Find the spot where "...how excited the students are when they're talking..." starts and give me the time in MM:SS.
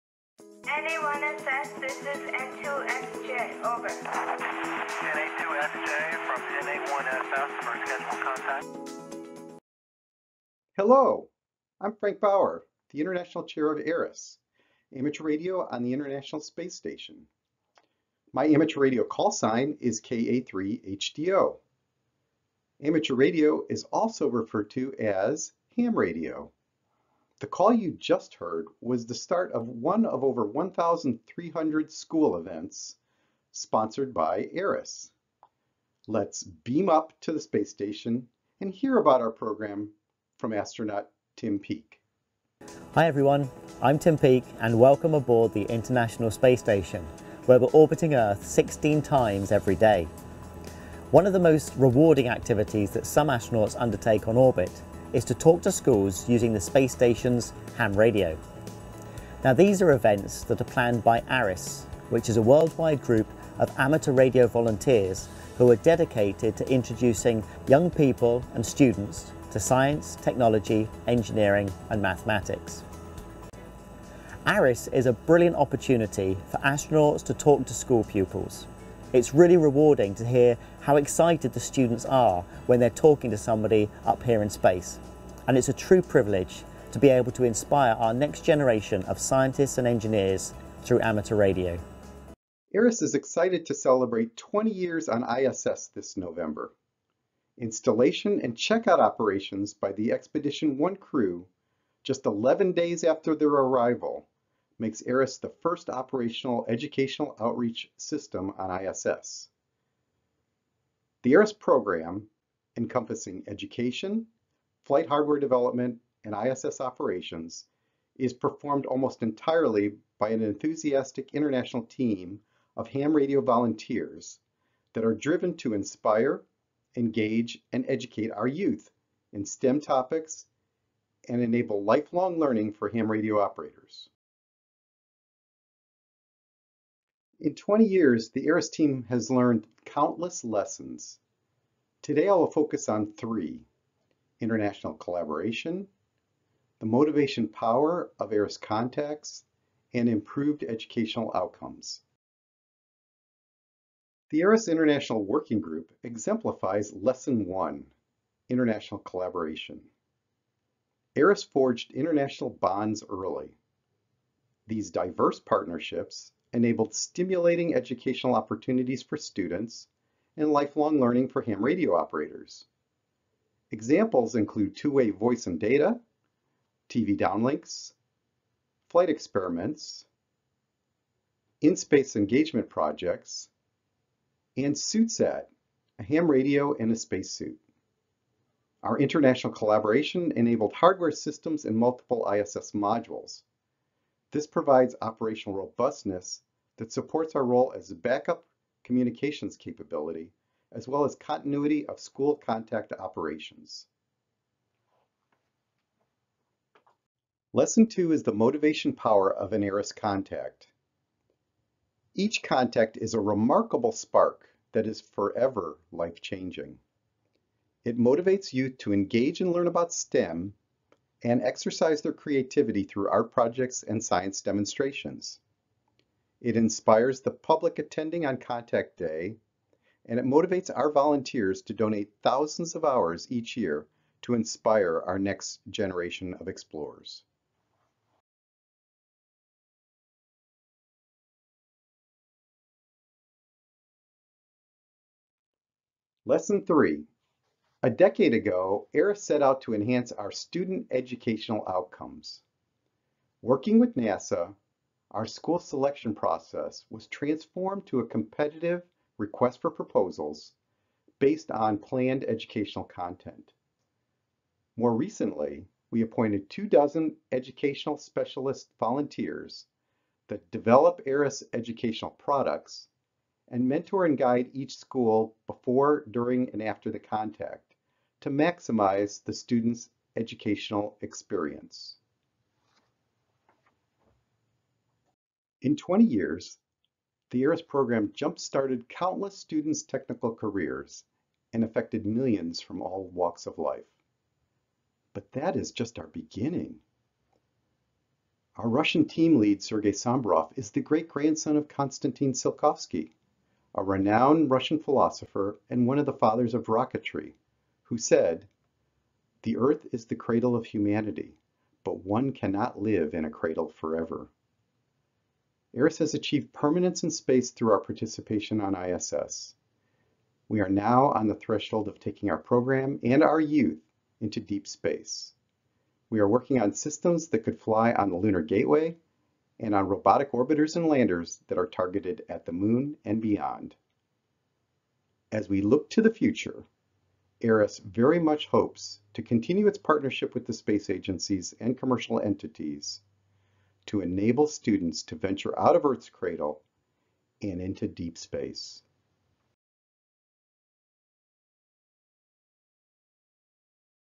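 01:20.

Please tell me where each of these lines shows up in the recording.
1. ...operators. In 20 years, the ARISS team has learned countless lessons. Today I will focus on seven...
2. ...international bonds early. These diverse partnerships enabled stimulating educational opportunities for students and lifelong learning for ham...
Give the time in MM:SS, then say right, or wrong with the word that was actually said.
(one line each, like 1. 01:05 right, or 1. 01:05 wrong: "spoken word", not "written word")
1. 02:13 wrong: "three", not "seven"
2. 02:41 right.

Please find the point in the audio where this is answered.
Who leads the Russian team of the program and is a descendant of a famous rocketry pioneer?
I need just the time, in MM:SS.
04:59.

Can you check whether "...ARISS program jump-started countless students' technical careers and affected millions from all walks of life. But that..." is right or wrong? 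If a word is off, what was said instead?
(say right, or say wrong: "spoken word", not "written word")
right.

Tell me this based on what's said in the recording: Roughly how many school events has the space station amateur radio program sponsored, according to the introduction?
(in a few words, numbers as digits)
over 1,300.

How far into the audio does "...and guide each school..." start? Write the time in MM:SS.
04:34.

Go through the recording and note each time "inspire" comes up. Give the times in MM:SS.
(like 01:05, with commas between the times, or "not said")
01:27, 02:05, 03:46, 03:54.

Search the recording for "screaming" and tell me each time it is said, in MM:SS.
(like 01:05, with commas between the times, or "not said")
not said.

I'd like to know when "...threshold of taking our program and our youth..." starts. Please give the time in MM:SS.
05:21.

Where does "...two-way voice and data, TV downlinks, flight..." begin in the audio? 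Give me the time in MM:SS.
02:54.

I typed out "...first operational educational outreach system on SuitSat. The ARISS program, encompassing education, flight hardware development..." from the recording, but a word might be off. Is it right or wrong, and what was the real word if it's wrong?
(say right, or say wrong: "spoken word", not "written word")
wrong: "ISS", not "SuitSat".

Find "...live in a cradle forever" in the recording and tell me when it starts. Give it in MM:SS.
05:12.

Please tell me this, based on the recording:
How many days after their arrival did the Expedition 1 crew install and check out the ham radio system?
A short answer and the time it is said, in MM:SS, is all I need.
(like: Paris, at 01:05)
11 days, at 01:42.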